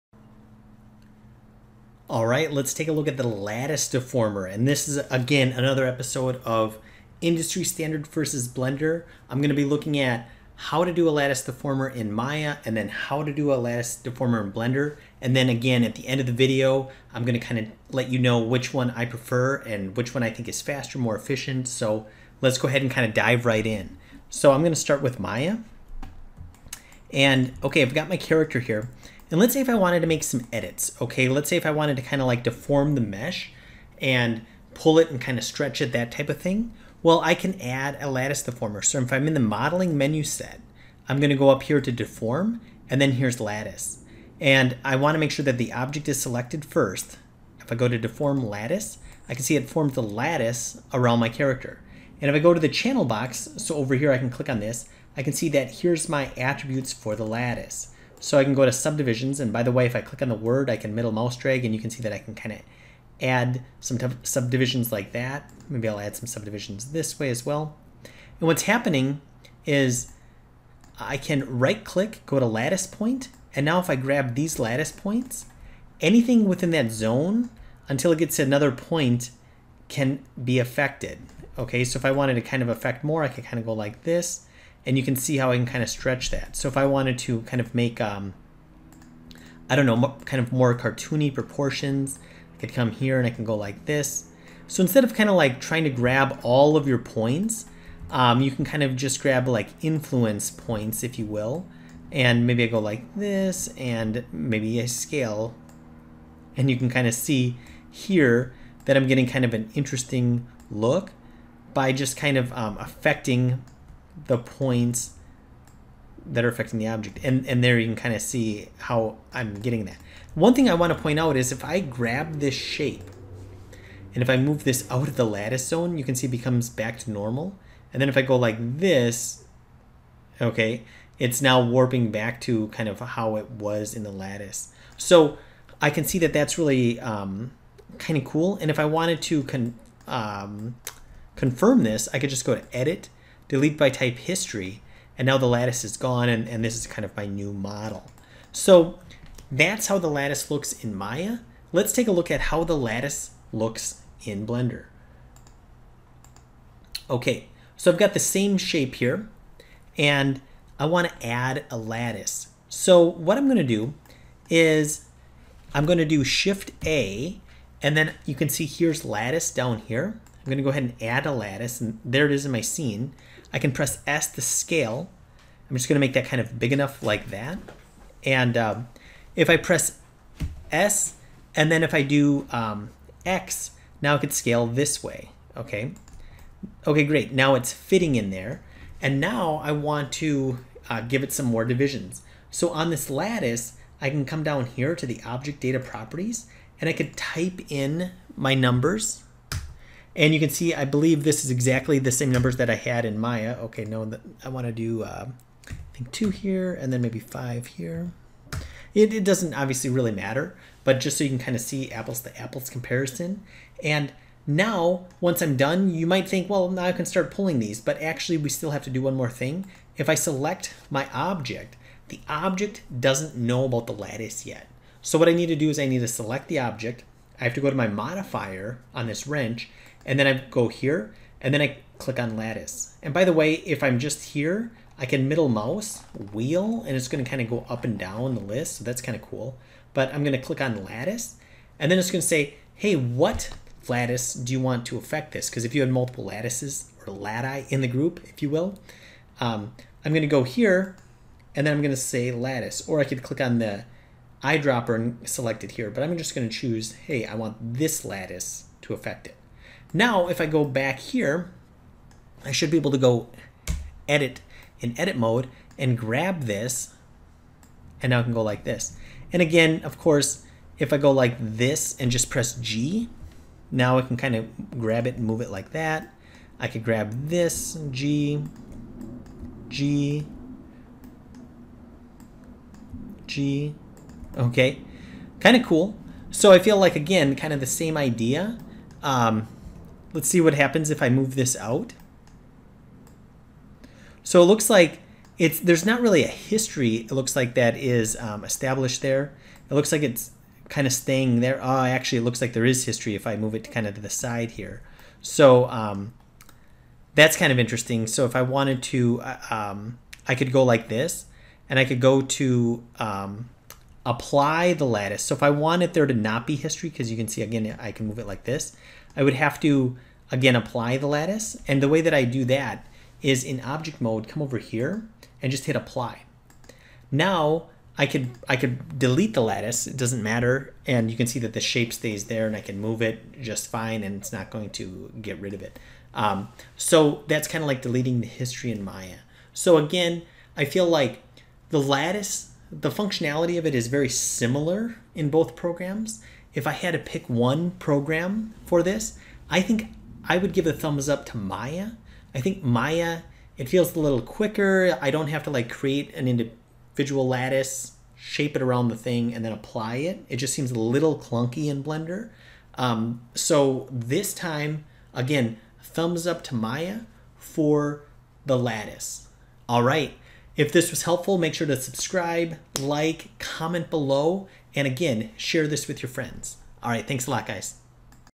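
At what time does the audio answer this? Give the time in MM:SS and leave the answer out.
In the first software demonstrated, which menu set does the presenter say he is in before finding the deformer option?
00:39.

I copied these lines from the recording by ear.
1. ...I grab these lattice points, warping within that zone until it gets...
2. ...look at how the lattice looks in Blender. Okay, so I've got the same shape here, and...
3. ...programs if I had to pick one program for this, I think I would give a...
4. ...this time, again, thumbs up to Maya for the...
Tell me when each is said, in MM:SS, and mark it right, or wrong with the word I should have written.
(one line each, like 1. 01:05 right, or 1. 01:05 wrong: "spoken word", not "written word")
1. 01:13 wrong: "anything", not "warping"
2. 02:32 right
3. 05:45 right
4. 06:03 right.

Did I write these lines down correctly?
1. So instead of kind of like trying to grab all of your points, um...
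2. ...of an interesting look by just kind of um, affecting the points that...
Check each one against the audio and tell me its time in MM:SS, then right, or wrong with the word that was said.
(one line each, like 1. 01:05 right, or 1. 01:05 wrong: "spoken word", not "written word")
1. 01:34 right
2. 01:49 right.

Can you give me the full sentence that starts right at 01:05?
Maybe I'll add some subdivisions this way as well.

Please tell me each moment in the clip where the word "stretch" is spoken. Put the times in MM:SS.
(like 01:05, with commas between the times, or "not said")
00:35, 01:25.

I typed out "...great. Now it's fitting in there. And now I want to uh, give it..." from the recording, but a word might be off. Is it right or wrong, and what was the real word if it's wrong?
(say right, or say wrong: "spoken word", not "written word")
right.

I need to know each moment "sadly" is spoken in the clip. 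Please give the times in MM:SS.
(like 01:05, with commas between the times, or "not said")
not said.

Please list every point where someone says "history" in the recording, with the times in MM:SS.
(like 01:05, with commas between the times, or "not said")
02:24, 04:56, 05:02, 05:16, 05:38.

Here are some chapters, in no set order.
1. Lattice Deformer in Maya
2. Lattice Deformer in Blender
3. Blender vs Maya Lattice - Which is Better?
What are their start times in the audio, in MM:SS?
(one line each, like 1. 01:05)
1. 00:26
2. 02:38
3. 05:42.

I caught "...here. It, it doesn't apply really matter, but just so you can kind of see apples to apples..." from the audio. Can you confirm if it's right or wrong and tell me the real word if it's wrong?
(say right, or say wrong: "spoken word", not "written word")
wrong: "obviously", not "apply".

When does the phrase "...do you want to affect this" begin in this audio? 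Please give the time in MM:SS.
04:04.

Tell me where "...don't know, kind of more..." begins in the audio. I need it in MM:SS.
01:29.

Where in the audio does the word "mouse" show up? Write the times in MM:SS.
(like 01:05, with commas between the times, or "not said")
01:01, 03:55.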